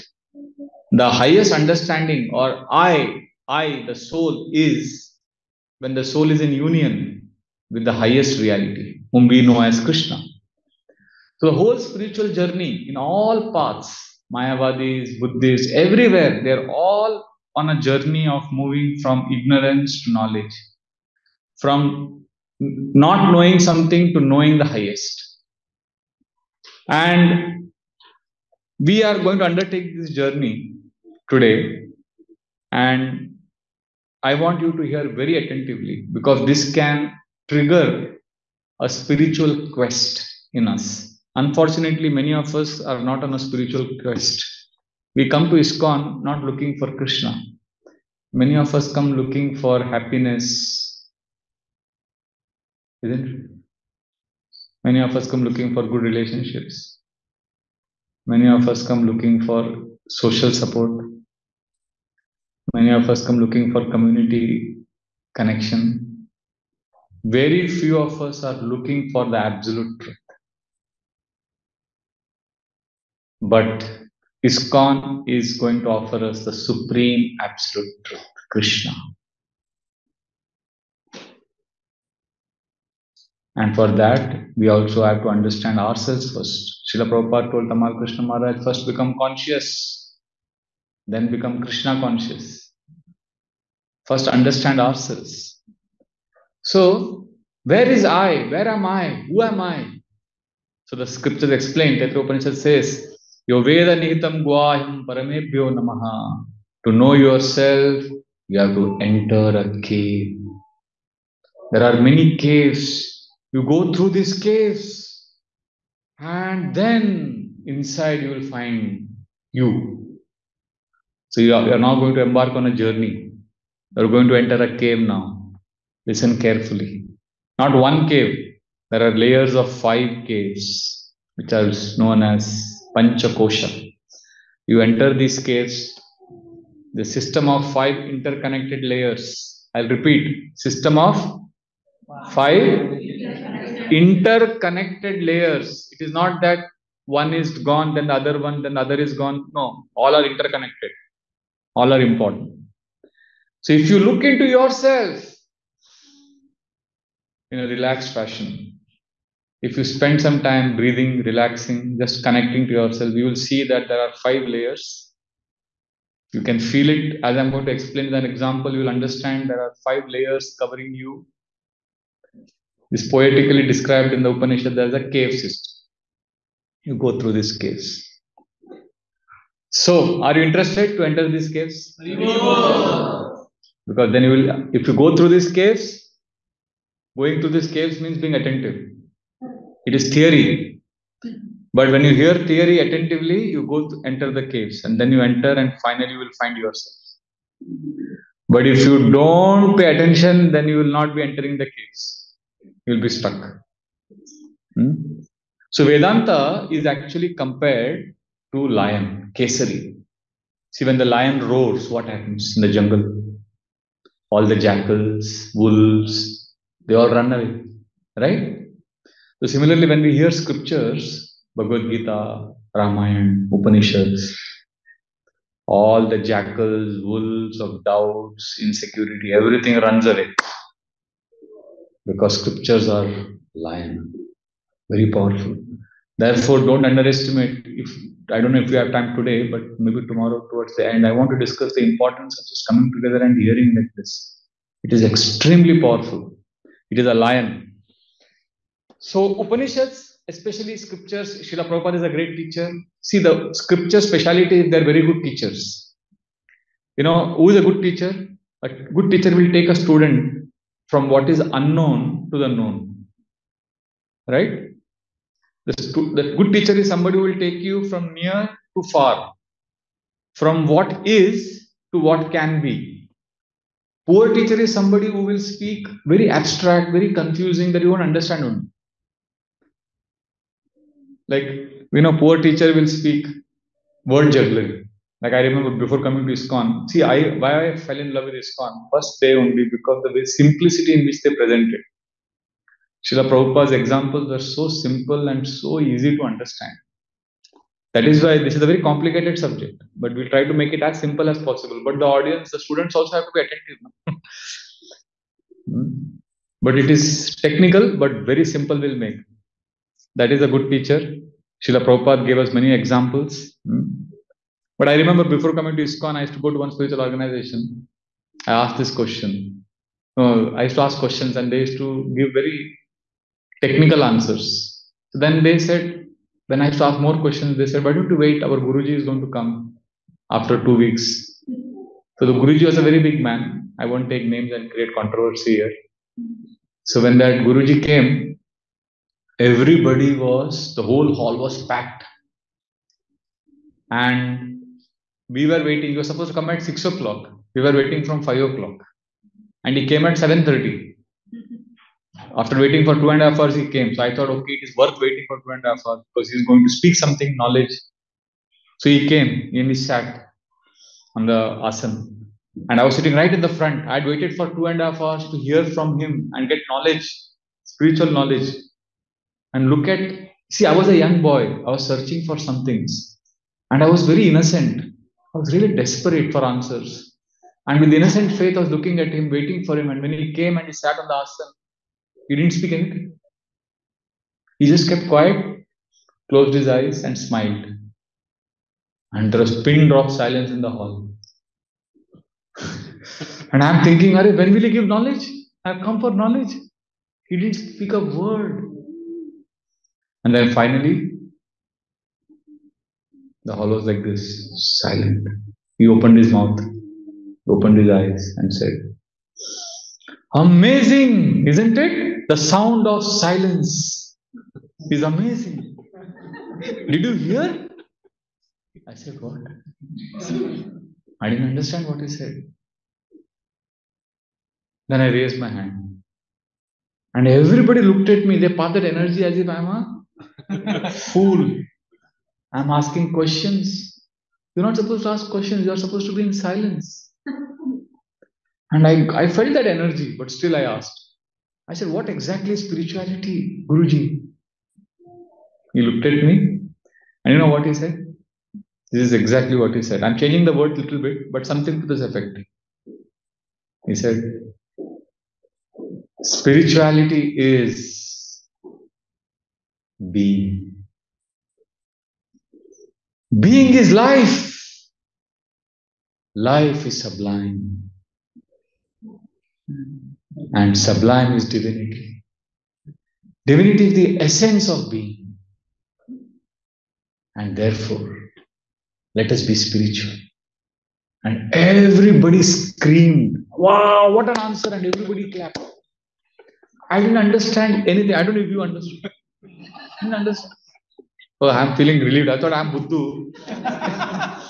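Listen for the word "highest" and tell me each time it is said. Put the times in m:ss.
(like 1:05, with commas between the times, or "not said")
0:01, 0:07, 0:24.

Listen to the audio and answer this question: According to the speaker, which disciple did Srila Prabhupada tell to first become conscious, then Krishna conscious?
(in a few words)
Tamal Krishna Maharaj.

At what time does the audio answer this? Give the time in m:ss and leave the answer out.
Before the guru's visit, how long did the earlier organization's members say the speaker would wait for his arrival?
5:30.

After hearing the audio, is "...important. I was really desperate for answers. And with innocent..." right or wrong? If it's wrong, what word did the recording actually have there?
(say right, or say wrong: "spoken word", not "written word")
wrong: "innocent", not "important".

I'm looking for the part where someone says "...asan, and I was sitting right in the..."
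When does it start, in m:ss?
6:01.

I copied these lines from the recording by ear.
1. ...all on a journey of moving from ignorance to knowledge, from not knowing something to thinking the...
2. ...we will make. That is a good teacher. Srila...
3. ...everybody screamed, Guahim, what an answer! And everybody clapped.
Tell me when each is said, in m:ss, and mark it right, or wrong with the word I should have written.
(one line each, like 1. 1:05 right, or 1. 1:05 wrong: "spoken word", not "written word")
1. 0:16 wrong: "knowing", not "thinking"
2. 5:08 right
3. 8:01 wrong: "Wow", not "Guahim".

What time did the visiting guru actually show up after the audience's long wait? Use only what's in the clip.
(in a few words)
7:30.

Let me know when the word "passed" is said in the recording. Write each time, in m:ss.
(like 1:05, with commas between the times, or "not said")
7:08.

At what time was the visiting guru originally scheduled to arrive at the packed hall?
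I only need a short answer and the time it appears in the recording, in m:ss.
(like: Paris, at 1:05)
6 o'clock, at 5:46.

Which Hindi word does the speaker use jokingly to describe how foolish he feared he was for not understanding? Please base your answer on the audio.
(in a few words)
Buddhu.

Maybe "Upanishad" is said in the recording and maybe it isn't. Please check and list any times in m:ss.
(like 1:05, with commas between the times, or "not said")
1:42, 2:54, 3:43, 4:09.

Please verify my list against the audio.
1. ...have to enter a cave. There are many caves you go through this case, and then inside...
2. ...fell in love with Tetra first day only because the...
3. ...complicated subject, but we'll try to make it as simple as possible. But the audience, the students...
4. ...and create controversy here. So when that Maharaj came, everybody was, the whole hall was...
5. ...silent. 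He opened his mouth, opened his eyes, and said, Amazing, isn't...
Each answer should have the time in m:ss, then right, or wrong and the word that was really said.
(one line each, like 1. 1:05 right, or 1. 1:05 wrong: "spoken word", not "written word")
1. 1:48 right
2. 4:47 wrong: "ISKCON", not "Tetra"
3. 4:58 right
4. 5:34 wrong: "Guruji", not "Maharaj"
5. 6:44 right.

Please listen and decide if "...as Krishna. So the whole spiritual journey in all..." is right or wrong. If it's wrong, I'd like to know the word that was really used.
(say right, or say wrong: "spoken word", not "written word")
right.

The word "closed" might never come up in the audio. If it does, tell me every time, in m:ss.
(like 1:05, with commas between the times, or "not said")
6:26.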